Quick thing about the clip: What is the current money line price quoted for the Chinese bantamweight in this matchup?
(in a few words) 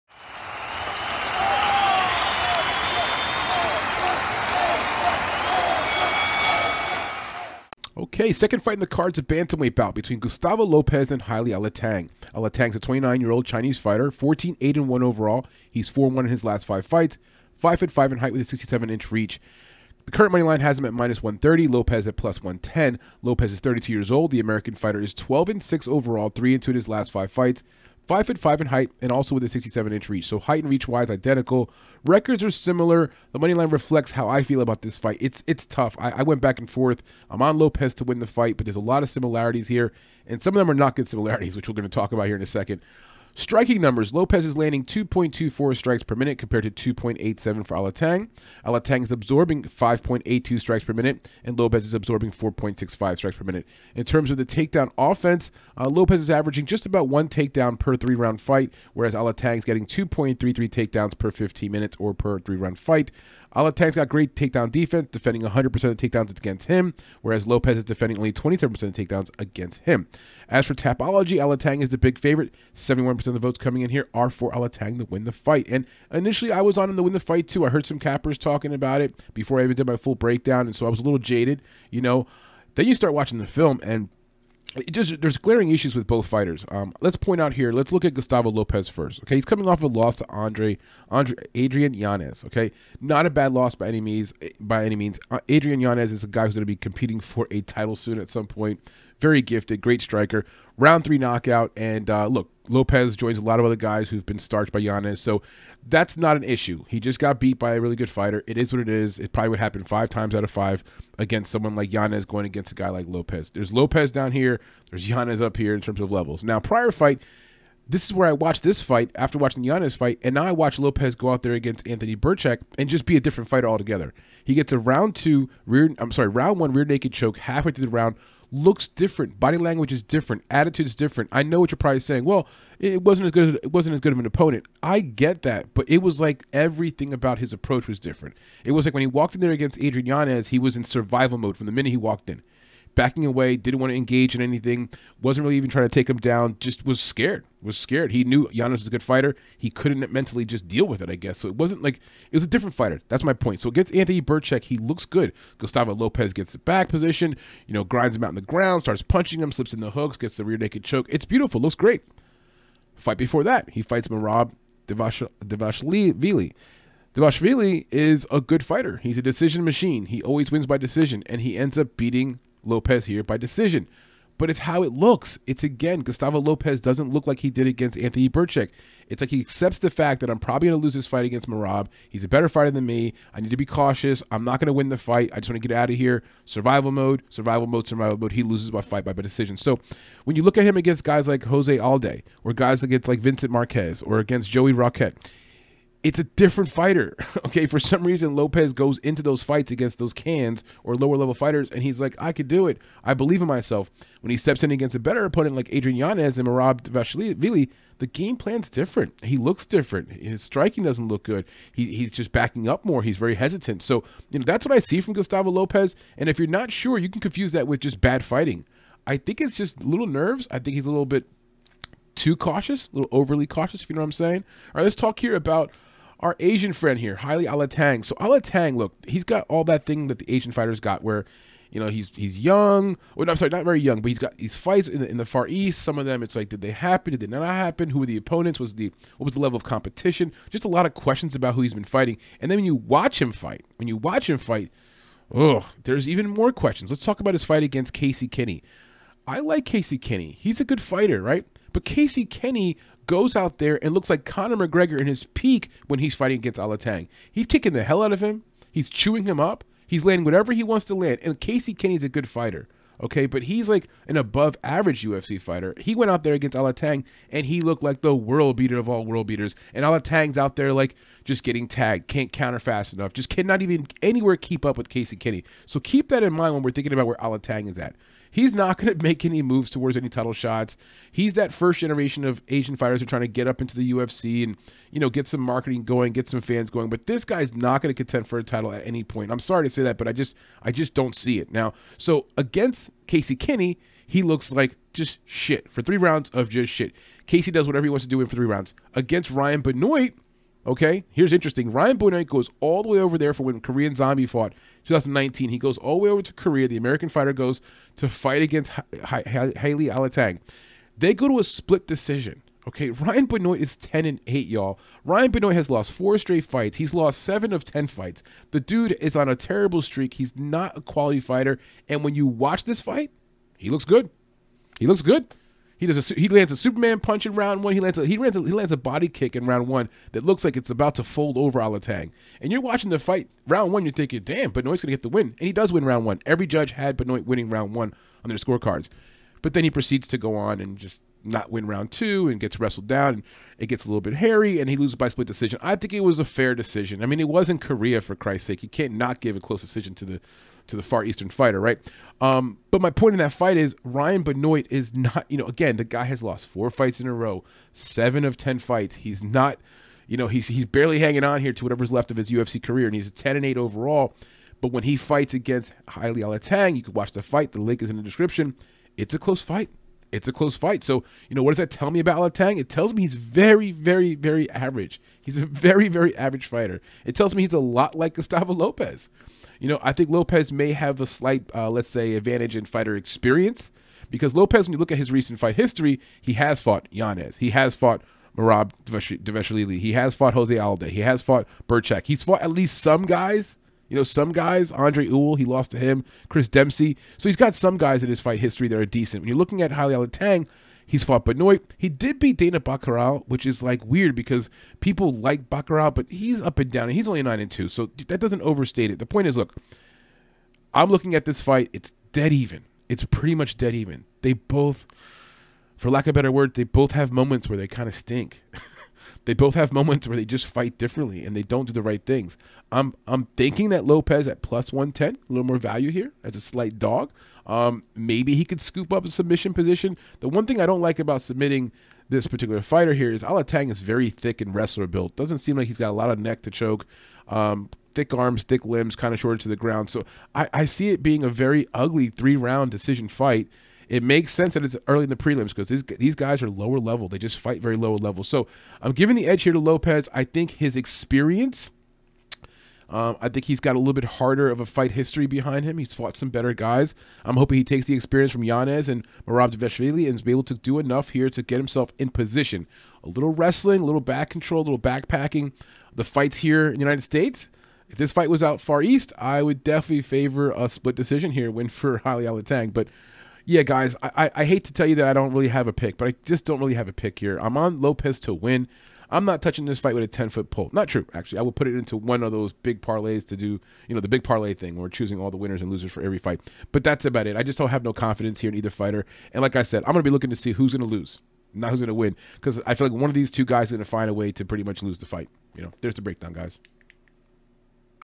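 -130.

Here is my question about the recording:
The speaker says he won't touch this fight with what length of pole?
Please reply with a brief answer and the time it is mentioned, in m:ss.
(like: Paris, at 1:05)
10 foot, at 8:00.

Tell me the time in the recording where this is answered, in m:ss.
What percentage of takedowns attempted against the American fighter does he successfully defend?
1:08.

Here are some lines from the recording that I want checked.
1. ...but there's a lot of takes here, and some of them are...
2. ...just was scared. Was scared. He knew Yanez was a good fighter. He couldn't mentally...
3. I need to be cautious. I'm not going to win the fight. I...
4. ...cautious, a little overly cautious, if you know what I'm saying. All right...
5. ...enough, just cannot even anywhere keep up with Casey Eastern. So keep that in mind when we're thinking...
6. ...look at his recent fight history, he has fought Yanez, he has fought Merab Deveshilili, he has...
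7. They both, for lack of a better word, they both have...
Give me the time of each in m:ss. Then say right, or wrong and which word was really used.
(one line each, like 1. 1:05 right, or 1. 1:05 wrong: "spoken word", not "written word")
1. 0:38 wrong: "similarities", not "takes"
2. 2:26 right
3. 3:03 right
4. 3:42 right
5. 4:32 wrong: "Kenney", not "Eastern"
6. 6:24 right
7. 6:54 right.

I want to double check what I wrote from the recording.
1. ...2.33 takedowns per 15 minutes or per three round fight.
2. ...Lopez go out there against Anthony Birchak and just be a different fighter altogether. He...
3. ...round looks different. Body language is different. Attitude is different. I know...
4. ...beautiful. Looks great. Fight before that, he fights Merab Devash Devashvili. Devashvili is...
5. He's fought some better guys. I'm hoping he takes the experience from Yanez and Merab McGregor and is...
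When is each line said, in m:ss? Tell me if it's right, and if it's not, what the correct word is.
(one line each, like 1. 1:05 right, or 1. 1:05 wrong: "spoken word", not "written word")
1. 0:59 right
2. 2:00 right
3. 2:07 right
4. 2:41 right
5. 7:35 wrong: "Deveshvili", not "McGregor".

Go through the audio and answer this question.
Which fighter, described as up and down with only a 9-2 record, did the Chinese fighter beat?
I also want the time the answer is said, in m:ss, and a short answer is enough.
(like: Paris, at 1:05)
Dana Batgerel, at 6:42.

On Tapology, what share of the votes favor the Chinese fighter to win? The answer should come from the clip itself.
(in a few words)
71%.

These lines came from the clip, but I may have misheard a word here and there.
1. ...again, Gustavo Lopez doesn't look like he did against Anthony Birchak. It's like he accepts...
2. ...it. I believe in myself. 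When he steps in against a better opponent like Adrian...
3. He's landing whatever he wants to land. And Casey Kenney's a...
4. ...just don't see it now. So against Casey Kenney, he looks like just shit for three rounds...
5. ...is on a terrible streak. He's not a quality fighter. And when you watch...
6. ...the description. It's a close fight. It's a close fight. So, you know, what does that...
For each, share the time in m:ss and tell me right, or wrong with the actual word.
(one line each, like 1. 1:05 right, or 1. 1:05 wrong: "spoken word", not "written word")
1. 2:55 right
2. 3:22 right
3. 4:19 right
4. 4:50 right
5. 5:19 right
6. 6:07 right.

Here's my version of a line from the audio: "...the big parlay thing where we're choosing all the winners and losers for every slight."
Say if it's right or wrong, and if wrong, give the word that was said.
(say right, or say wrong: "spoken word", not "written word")
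wrong: "fight", not "slight".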